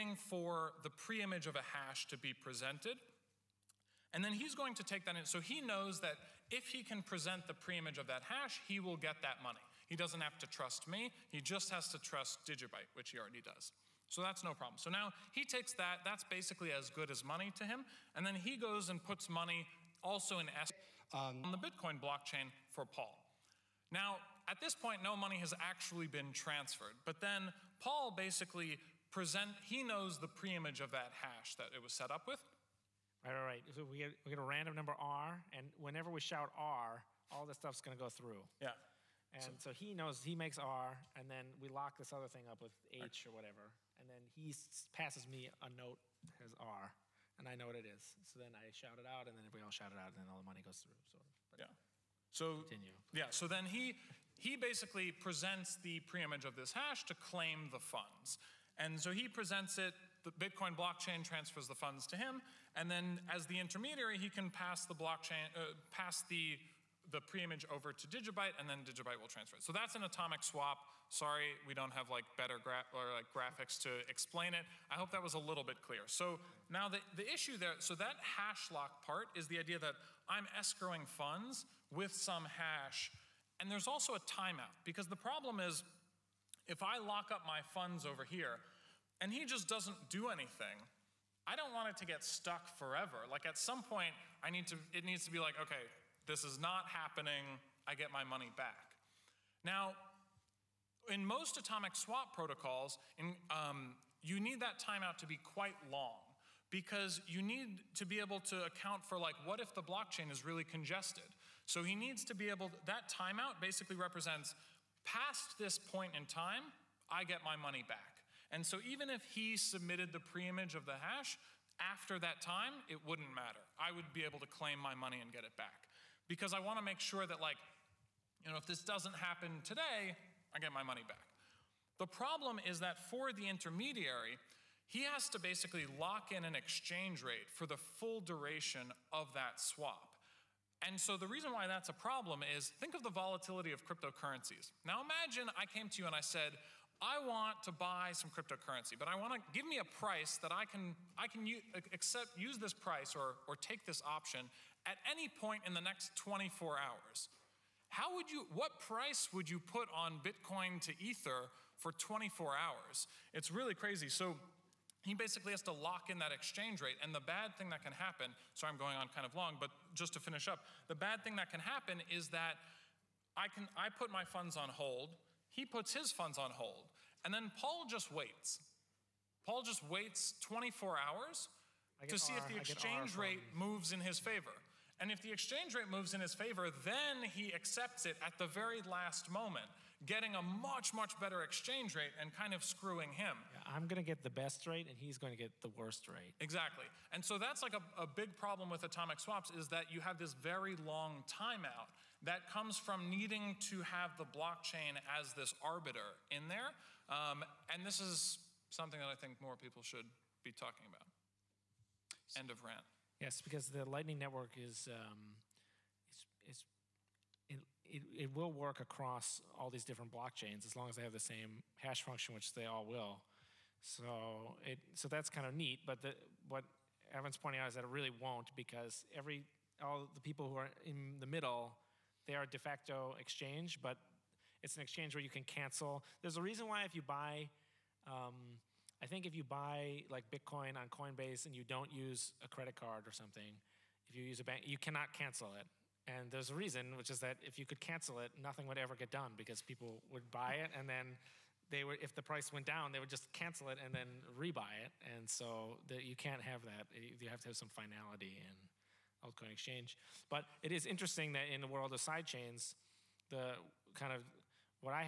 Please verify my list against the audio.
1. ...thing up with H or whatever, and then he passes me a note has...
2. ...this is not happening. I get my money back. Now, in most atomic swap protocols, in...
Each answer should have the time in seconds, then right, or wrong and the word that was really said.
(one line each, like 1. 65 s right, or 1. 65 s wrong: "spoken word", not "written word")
1. 42 s right
2. 96 s right.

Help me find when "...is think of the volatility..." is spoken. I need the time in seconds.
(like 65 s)
142 s.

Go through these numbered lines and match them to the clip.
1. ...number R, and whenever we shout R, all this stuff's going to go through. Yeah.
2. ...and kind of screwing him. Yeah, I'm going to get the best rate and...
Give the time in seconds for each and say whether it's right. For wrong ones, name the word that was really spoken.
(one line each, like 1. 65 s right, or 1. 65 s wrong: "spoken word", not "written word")
1. 34 s right
2. 192 s right.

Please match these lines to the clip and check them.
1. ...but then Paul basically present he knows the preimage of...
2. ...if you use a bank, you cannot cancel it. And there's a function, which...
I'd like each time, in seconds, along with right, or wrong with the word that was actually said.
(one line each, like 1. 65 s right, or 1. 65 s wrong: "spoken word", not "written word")
1. 27 s right
2. 244 s wrong: "reason", not "function".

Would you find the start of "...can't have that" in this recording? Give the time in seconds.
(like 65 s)
256 s.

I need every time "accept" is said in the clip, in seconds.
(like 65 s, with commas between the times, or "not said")
151 s, 187 s.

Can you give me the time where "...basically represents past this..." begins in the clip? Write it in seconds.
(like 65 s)
113 s.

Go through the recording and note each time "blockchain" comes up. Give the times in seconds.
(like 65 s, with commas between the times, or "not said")
22 s, 60 s, 64 s, 109 s, 204 s, 220 s.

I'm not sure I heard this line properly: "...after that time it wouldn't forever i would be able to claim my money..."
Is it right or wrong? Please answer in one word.
wrong.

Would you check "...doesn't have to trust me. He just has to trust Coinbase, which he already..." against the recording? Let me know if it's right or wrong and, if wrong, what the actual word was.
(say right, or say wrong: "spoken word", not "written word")
wrong: "Digibyte", not "Coinbase".